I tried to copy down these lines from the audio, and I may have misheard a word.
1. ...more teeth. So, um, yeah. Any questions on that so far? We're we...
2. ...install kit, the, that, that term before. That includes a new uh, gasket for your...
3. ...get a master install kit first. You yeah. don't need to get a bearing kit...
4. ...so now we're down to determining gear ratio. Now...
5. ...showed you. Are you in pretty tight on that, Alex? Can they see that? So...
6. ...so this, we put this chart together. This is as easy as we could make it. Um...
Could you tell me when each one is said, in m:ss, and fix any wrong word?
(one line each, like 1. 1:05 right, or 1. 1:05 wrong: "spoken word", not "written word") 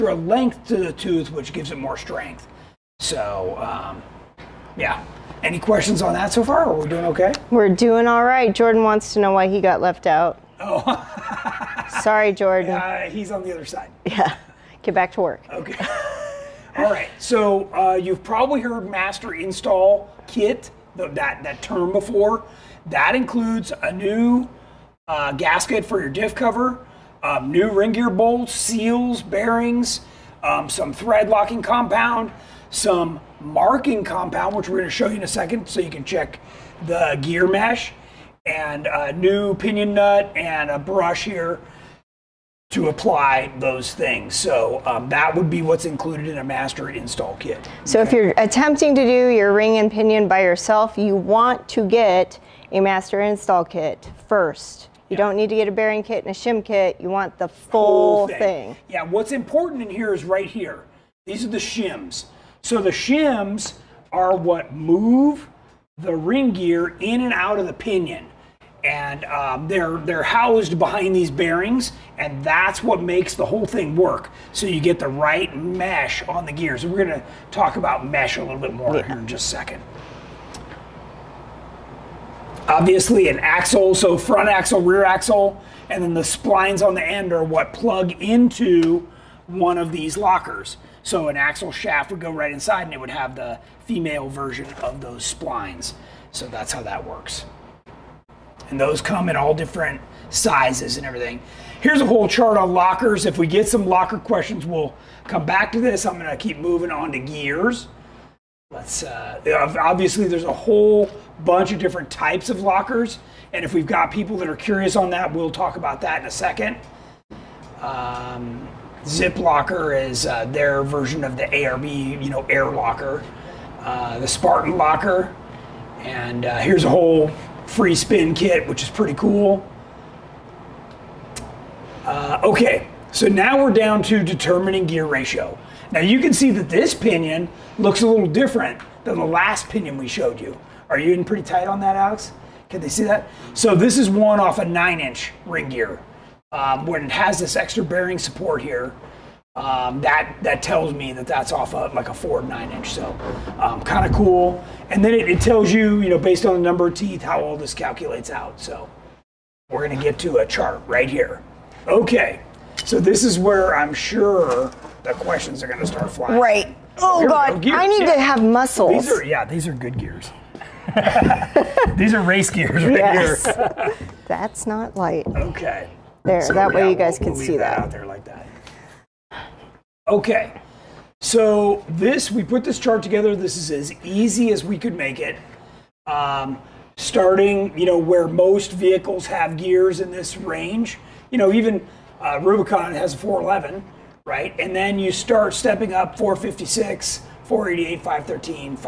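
1. 0:01 wrong: "strength", not "teeth"
2. 0:19 right
3. 0:51 right
4. 2:13 right
5. 2:20 right
6. 3:01 right.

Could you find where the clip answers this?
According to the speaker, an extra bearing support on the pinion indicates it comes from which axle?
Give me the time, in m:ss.
2:32.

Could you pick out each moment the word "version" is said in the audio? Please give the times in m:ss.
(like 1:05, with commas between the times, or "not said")
1:34, 2:00.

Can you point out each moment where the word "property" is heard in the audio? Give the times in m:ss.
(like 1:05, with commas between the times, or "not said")
not said.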